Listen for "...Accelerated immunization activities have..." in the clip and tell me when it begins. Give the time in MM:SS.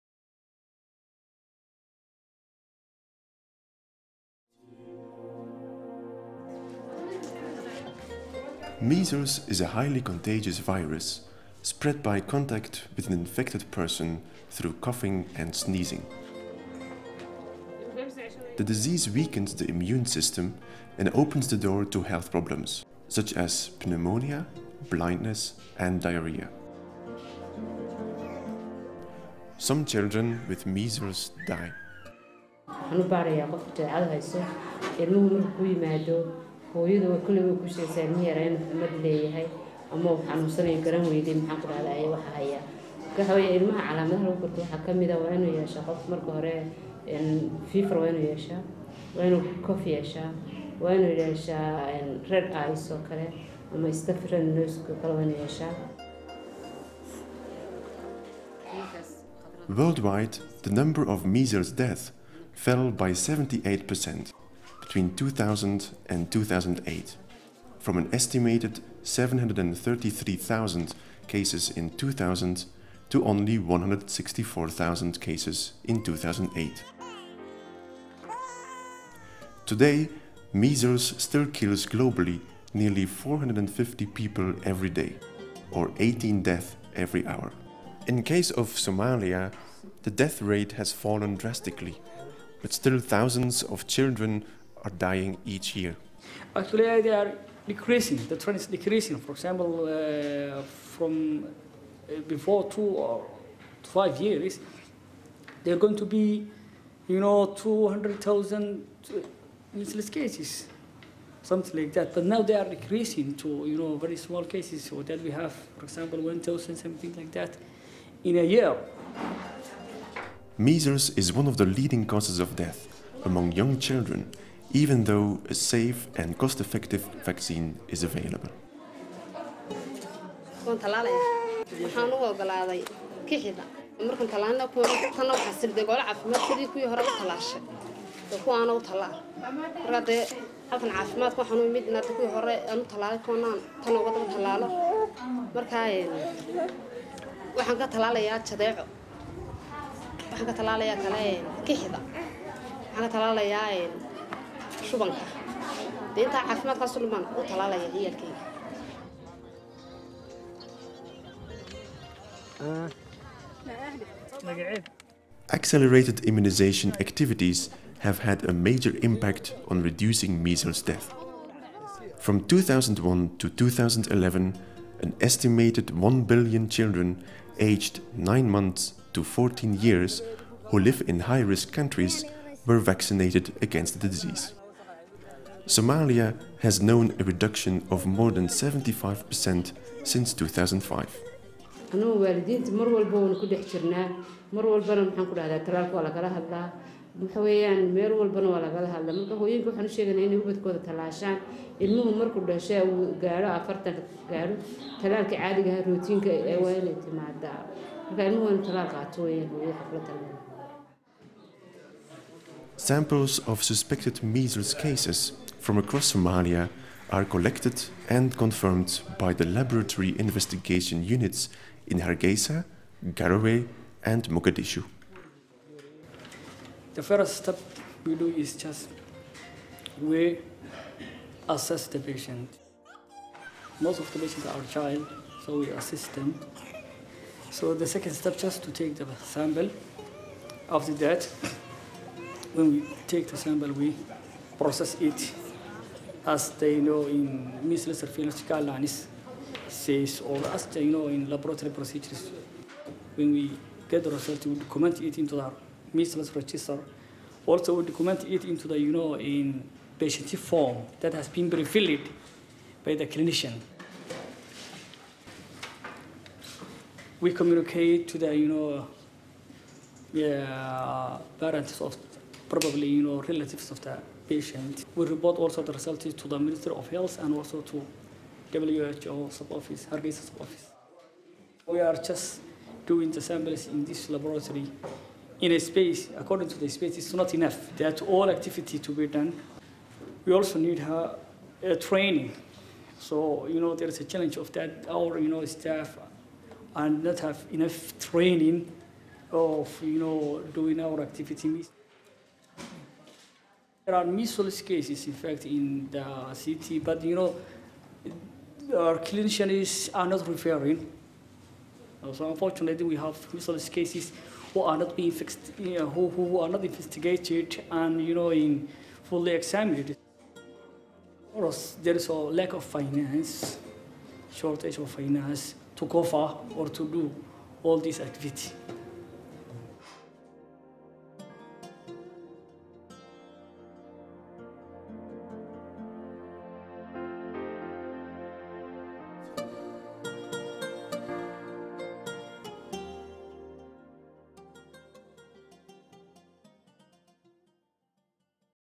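02:45.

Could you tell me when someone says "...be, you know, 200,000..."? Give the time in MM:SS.
01:46.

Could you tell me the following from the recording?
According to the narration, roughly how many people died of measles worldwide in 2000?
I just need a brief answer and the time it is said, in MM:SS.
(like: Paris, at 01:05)
733,000, at 01:09.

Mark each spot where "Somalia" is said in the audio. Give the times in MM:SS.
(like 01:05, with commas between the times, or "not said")
01:28, 03:05, 03:36.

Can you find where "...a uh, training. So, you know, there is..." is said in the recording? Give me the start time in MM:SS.
04:50.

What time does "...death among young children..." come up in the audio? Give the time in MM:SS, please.
02:02.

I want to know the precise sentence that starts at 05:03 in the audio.
There are measles cases, in fact, in the city, but you know, our clinicians are not referring.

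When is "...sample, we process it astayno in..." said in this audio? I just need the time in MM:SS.
04:03.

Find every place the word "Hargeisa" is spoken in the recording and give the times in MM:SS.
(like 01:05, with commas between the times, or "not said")
03:41, 04:39.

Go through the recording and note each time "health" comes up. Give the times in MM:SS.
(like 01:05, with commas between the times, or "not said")
00:22, 04:36.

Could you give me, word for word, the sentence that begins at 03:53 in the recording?
Most of the patients are child, so we assist them.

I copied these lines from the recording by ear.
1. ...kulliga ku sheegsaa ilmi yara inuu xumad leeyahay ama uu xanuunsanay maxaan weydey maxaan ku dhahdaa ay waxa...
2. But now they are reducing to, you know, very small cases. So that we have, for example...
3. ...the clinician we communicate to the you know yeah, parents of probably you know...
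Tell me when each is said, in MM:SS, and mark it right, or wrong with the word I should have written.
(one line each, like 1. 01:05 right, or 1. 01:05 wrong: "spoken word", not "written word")
1. 00:37 wrong: "garan", not "maxaan"
2. 01:52 wrong: "decreasing", not "reducing"
3. 04:22 right.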